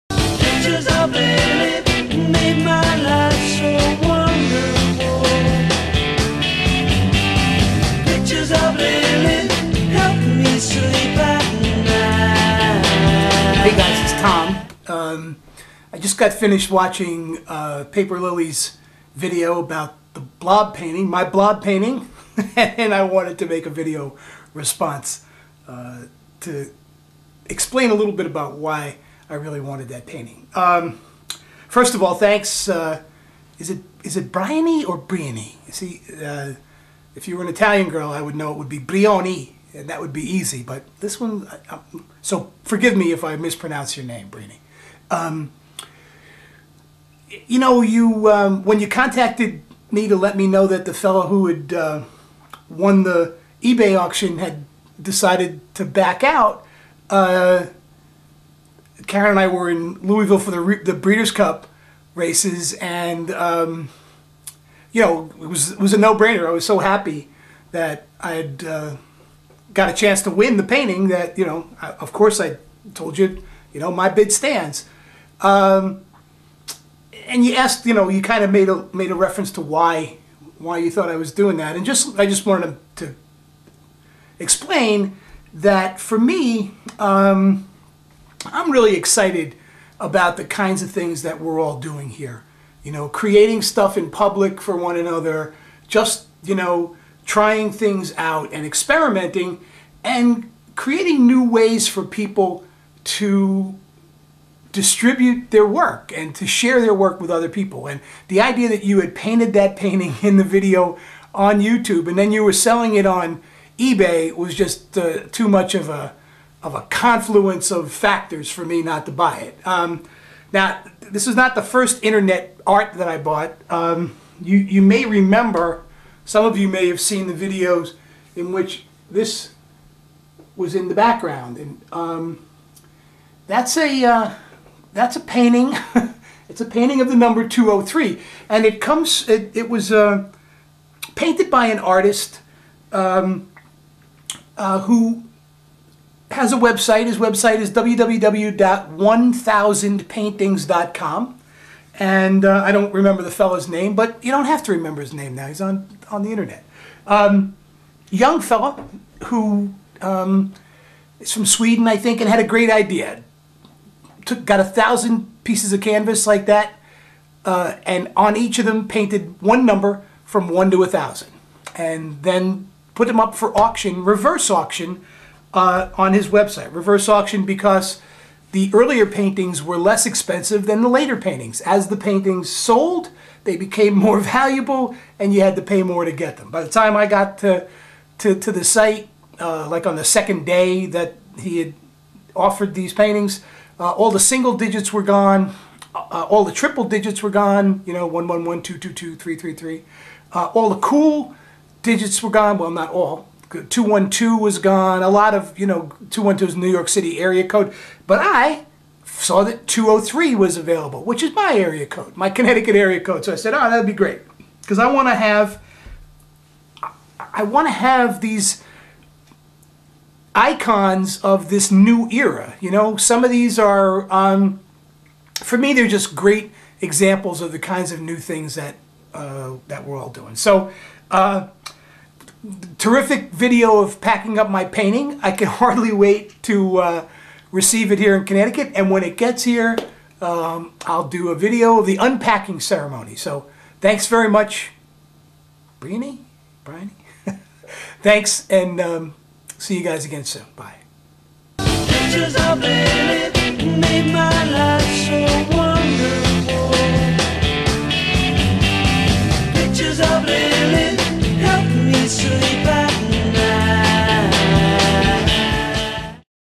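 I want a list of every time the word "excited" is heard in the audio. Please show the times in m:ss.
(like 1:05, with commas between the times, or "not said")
1:28.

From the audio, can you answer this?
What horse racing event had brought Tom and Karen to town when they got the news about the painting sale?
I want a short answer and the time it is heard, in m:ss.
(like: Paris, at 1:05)
Breeders' Cup, at 1:00.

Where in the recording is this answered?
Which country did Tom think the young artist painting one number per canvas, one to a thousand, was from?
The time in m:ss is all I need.
2:41.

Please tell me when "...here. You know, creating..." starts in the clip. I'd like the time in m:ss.
1:32.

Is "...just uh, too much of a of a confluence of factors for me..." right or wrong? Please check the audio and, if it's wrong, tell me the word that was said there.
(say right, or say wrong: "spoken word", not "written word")
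right.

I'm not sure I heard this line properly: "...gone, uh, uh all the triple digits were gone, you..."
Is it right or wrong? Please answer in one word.
right.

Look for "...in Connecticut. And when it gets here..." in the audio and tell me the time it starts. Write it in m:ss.
3:58.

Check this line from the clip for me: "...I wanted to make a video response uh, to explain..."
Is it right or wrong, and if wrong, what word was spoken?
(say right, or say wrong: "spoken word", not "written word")
right.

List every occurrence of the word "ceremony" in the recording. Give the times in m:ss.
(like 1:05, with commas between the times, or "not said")
4:02.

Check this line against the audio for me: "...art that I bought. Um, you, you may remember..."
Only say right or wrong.
right.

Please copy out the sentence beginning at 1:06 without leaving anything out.
I was so happy that I had uh, got a chance to win the painting.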